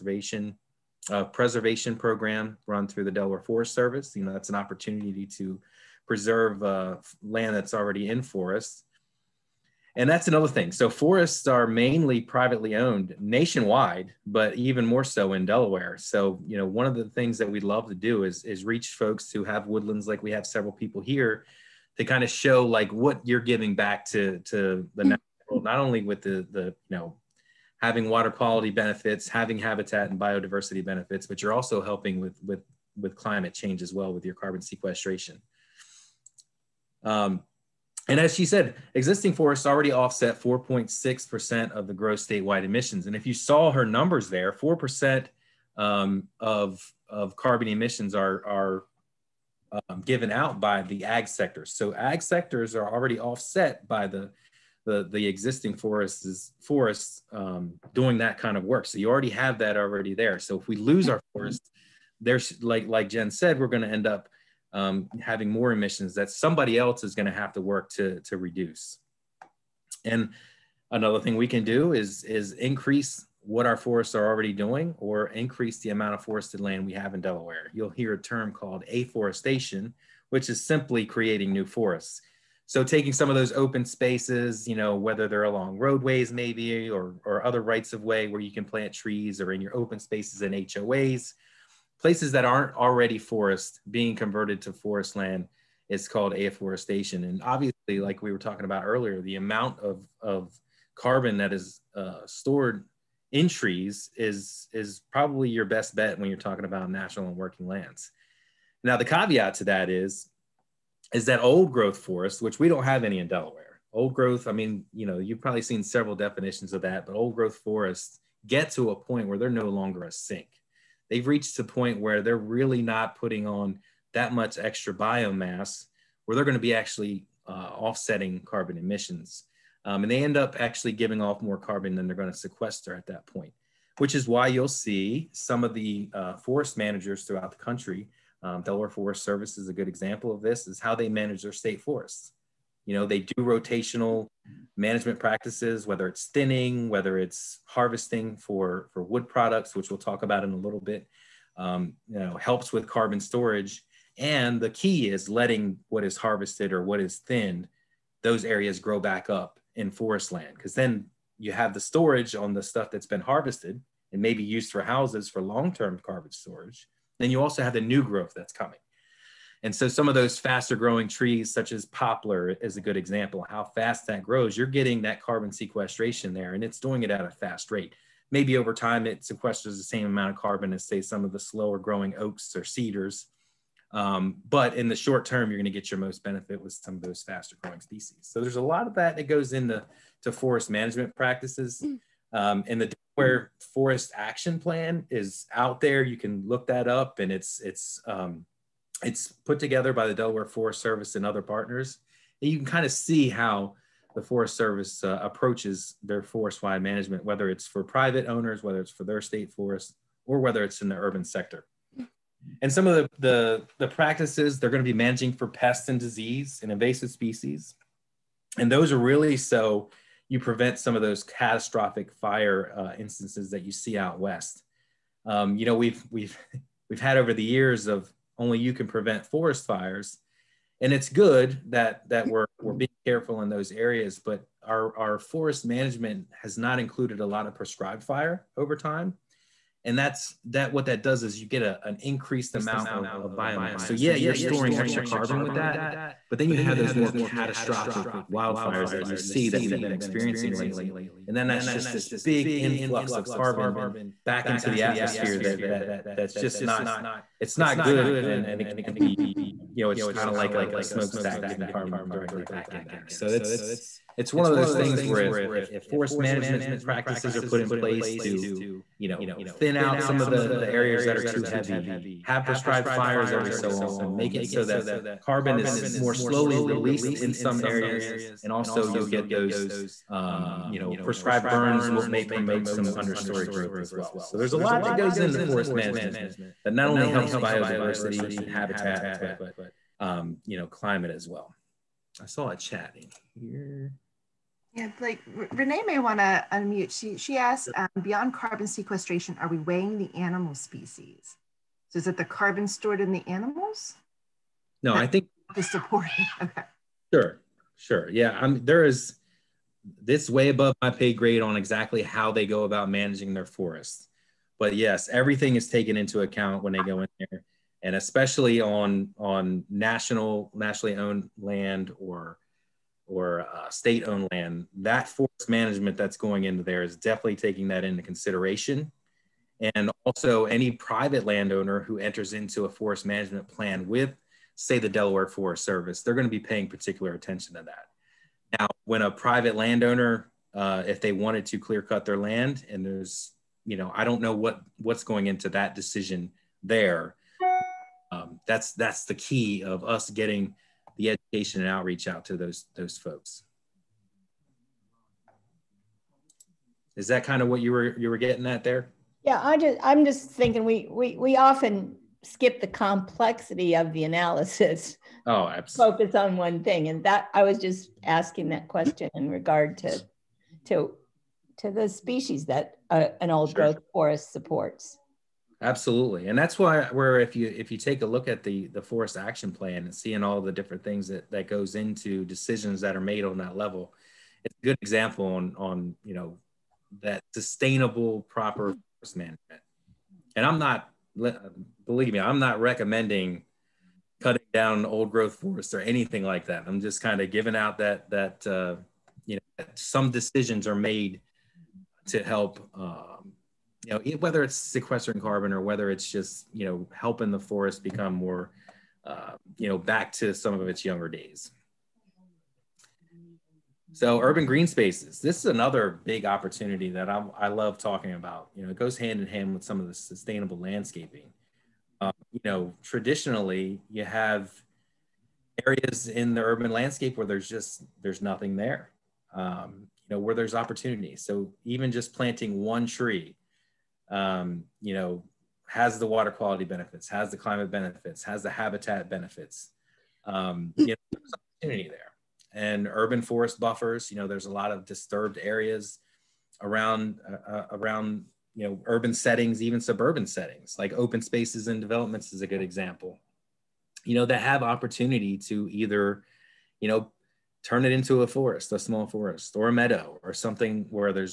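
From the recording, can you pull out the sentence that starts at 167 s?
Then you also have the new growth that's coming.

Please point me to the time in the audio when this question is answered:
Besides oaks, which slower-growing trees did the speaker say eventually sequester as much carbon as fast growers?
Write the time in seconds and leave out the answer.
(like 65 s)
182 s.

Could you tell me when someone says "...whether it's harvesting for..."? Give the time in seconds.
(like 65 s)
146 s.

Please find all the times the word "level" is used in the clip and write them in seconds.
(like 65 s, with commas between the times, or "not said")
383 s.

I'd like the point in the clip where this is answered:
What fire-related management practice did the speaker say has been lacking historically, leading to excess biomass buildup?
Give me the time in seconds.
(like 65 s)
237 s.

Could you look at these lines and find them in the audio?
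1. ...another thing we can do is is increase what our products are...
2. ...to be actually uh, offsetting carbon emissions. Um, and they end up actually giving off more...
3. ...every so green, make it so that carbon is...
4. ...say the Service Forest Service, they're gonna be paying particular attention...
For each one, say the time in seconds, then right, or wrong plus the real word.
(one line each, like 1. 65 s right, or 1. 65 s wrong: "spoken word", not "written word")
1. 70 s wrong: "forests", not "products"
2. 126 s right
3. 273 s wrong: "often", not "green"
4. 334 s wrong: "Delaware", not "Service".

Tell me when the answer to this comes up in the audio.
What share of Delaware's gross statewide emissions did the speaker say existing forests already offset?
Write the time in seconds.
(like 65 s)
40 s.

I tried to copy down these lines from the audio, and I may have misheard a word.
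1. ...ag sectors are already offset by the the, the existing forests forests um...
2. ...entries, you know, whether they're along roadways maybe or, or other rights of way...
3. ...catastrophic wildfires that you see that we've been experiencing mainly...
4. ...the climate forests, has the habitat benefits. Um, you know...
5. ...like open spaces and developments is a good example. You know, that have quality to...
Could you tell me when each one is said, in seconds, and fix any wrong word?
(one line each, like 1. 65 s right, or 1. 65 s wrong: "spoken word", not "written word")
1. 51 s right
2. 83 s wrong: "spaces", not "entries"
3. 247 s wrong: "lately", not "mainly"
4. 437 s wrong: "benefits", not "forests"
5. 450 s wrong: "opportunity", not "quality".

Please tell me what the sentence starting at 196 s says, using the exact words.
You can look that up, and it's it's um, it's put together by the Delaware Forest Service and other partners.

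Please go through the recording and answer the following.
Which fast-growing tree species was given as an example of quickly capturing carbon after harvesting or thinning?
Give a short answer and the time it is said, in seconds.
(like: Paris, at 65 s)
poplar, at 171 s.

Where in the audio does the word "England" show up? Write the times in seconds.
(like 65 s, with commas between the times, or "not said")
not said.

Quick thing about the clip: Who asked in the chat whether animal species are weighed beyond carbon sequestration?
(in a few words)
Renee.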